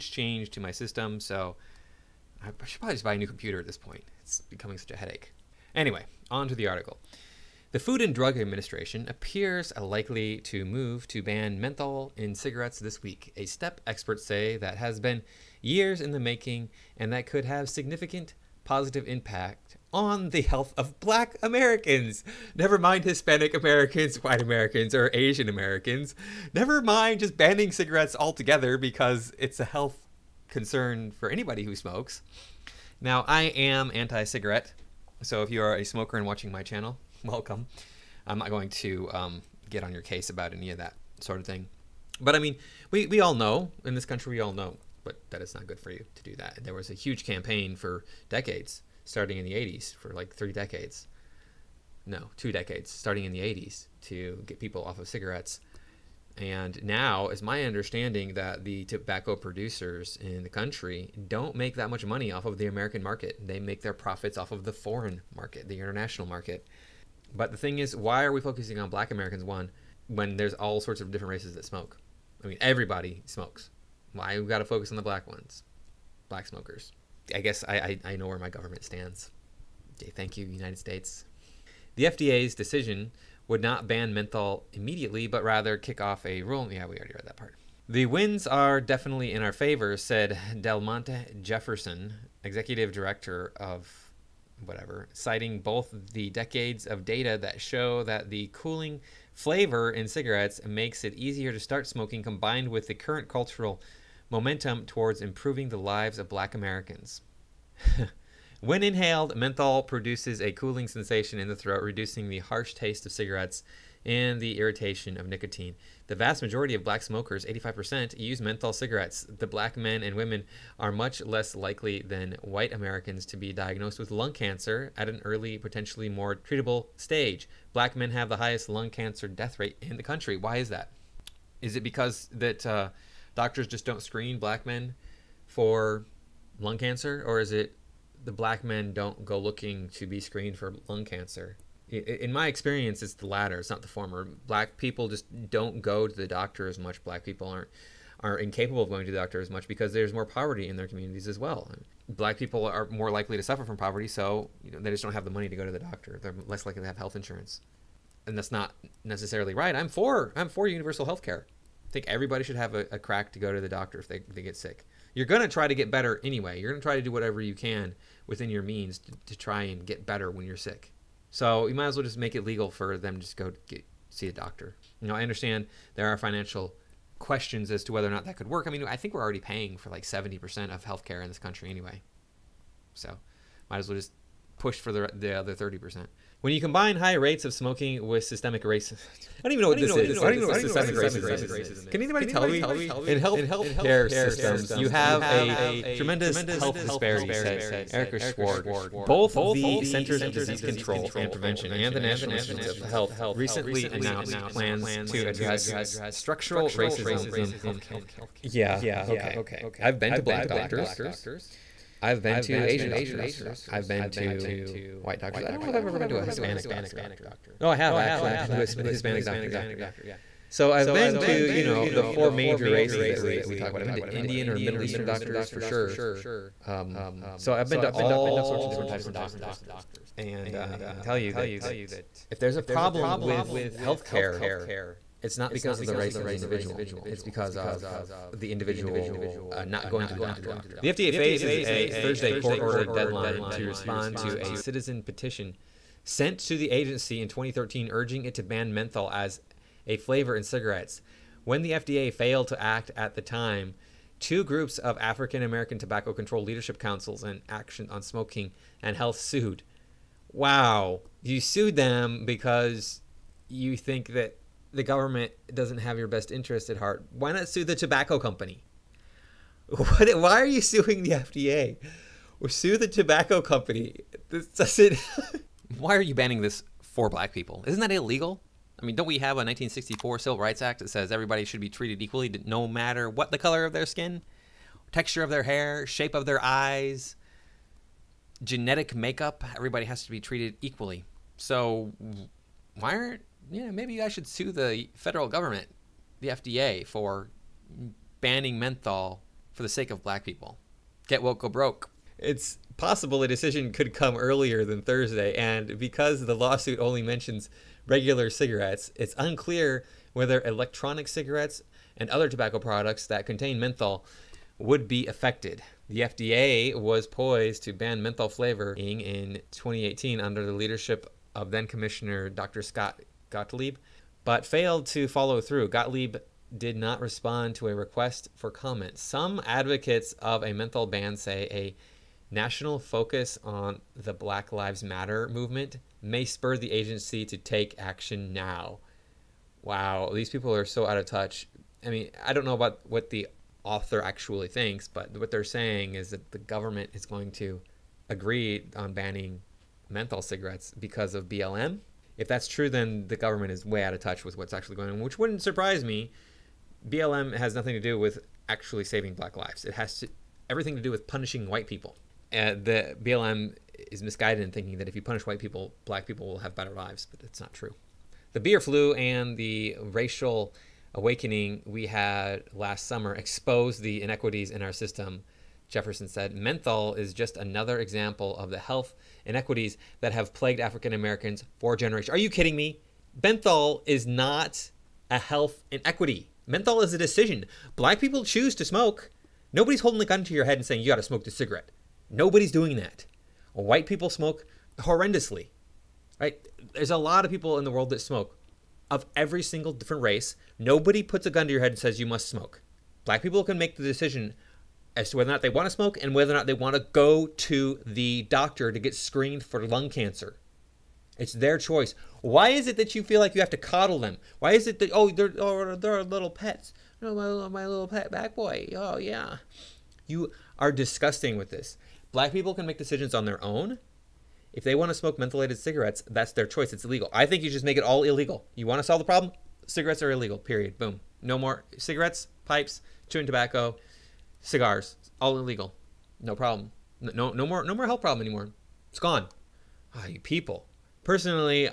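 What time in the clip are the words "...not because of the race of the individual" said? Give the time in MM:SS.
03:55.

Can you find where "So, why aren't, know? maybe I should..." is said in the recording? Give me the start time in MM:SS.
04:51.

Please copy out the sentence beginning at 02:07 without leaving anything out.
Black men have the highest lung cancer death rate in the country.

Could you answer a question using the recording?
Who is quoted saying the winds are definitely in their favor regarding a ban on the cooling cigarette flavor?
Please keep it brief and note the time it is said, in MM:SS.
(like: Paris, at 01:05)
Delmonte Jefferson, at 01:30.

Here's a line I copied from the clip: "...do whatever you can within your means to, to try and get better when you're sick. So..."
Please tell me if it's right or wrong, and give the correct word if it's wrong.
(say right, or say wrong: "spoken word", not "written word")
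right.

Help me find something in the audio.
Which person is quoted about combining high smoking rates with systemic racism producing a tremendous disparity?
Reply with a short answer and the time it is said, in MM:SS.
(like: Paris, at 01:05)
Erika Sward, at 03:17.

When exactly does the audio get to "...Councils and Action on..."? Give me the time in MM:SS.
04:16.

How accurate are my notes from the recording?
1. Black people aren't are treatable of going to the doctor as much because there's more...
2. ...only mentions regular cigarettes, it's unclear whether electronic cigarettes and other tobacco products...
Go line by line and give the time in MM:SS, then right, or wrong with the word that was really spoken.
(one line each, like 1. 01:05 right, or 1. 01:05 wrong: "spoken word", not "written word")
1. 02:27 wrong: "incapable", not "treatable"
2. 05:06 right.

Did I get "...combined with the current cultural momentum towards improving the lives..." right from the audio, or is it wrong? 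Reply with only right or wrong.
right.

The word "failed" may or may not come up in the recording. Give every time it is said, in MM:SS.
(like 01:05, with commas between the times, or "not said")
04:12, 05:24.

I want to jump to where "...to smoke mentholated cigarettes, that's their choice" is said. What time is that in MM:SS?
07:04.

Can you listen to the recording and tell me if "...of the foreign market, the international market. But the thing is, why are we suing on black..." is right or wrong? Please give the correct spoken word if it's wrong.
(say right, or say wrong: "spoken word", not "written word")
wrong: "focusing", not "suing".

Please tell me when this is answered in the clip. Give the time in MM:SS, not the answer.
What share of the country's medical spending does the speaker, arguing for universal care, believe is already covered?
03:00.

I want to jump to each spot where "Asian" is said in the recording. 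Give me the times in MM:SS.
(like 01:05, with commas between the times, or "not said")
00:25, 03:32.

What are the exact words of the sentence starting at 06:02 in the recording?
the BLM is misguided in thinking that if you punish white people, black people will have better lives, but it's not true.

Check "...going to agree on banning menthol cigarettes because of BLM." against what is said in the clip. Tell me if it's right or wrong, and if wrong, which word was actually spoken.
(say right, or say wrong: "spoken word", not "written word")
right.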